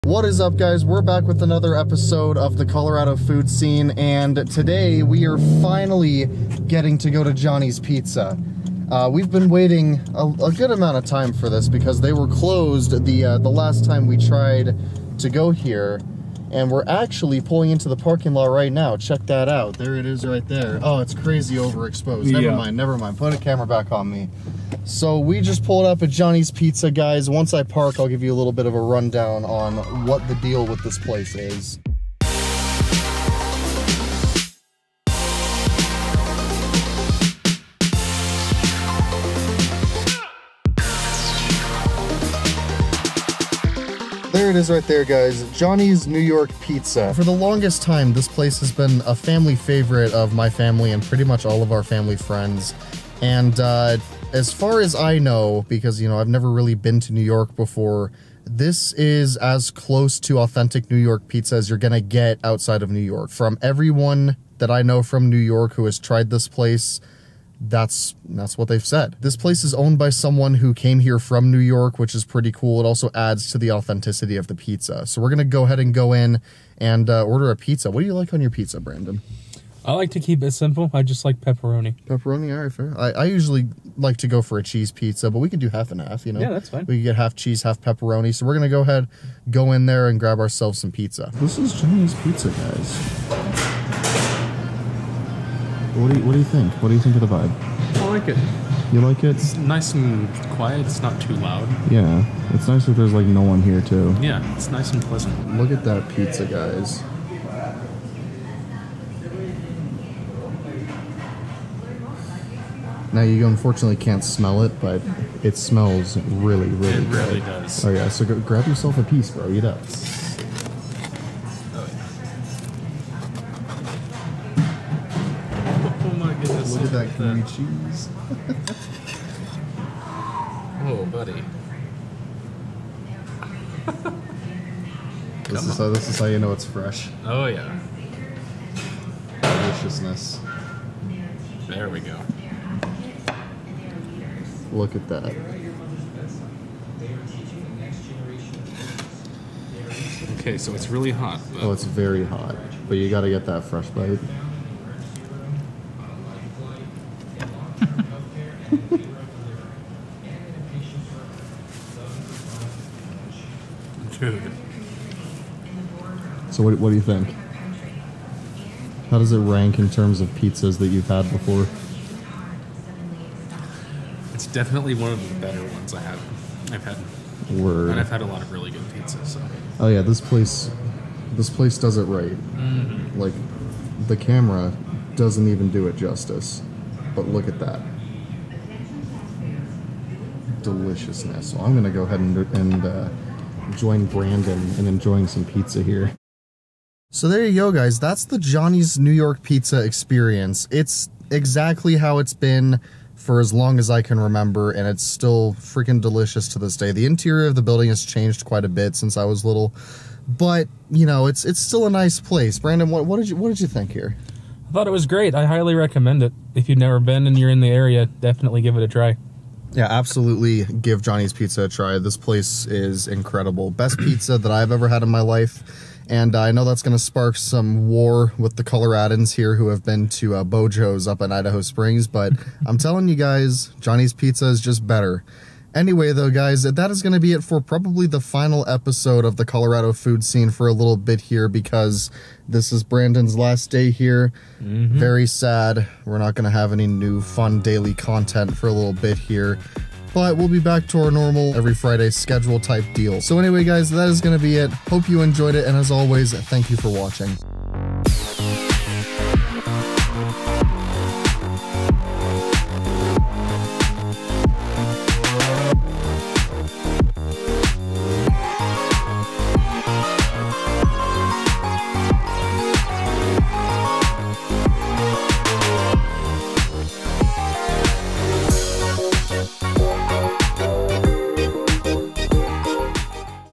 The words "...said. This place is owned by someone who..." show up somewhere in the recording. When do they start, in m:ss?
1:08.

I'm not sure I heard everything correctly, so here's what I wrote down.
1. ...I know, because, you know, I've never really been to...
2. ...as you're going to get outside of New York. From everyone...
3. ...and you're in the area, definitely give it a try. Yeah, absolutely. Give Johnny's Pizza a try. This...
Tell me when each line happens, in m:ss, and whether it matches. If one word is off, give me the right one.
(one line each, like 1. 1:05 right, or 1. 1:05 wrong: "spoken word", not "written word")
1. 0:54 right
2. 1:01 right
3. 3:37 right.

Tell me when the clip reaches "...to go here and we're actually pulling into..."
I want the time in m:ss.
0:15.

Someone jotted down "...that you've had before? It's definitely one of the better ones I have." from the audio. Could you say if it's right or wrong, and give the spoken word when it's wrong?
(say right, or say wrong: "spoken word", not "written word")
right.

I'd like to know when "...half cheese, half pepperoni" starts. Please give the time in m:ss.
1:27.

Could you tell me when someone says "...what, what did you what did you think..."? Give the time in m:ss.
3:32.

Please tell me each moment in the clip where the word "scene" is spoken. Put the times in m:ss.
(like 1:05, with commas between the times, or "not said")
0:03, 4:00.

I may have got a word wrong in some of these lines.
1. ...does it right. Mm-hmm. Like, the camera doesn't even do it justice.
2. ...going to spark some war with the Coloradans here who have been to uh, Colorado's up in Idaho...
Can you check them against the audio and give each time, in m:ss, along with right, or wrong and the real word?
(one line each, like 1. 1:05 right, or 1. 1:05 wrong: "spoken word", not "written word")
1. 3:01 right
2. 3:46 wrong: "BeauJo", not "Colorado".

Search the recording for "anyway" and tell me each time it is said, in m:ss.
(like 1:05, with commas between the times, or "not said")
3:55, 4:13.